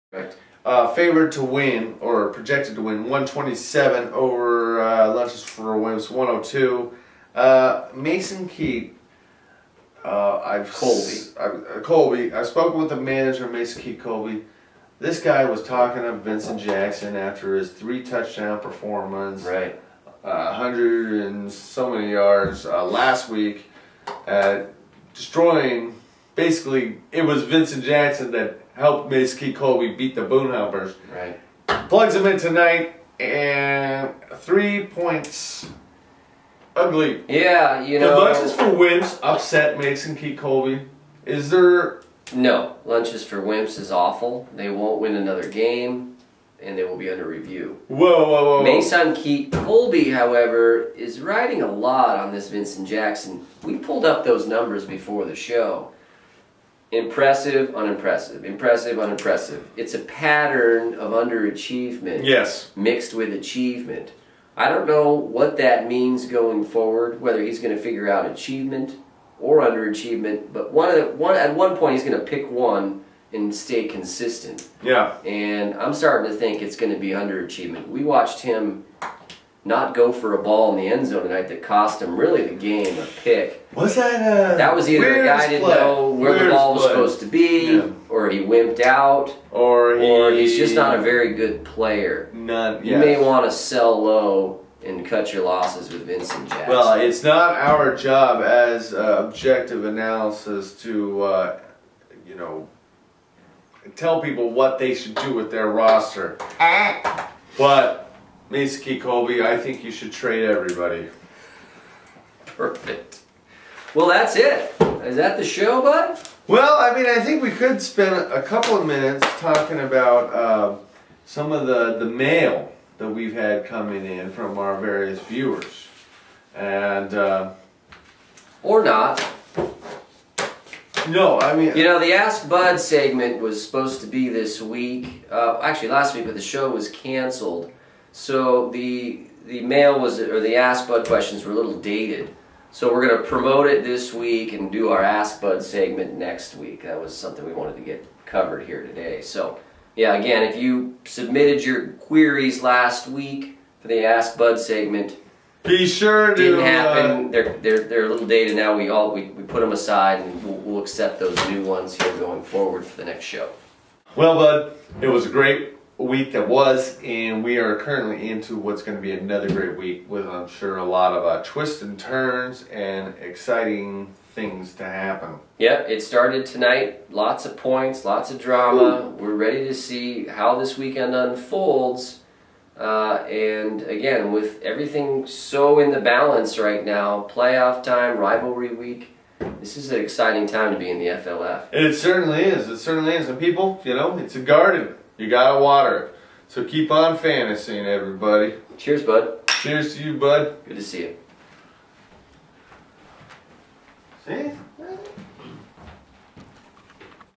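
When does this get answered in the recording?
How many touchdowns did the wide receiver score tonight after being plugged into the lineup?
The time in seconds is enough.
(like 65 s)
34 s.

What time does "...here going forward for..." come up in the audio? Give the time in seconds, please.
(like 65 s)
162 s.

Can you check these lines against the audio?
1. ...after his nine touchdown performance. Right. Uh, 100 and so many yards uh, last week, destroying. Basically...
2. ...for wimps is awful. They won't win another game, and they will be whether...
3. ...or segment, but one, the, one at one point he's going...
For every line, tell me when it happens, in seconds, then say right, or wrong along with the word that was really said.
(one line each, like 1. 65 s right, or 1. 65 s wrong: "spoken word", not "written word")
1. 17 s wrong: "three", not "nine"
2. 43 s wrong: "under", not "whether"
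3. 69 s wrong: "underachievement", not "segment".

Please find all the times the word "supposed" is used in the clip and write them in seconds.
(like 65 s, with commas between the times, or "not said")
86 s, 133 s.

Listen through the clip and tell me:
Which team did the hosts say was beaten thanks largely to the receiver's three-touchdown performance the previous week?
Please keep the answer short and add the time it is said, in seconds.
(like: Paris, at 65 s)
Boone Helpers, at 30 s.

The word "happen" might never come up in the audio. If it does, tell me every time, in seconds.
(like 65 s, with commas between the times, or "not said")
156 s, 174 s.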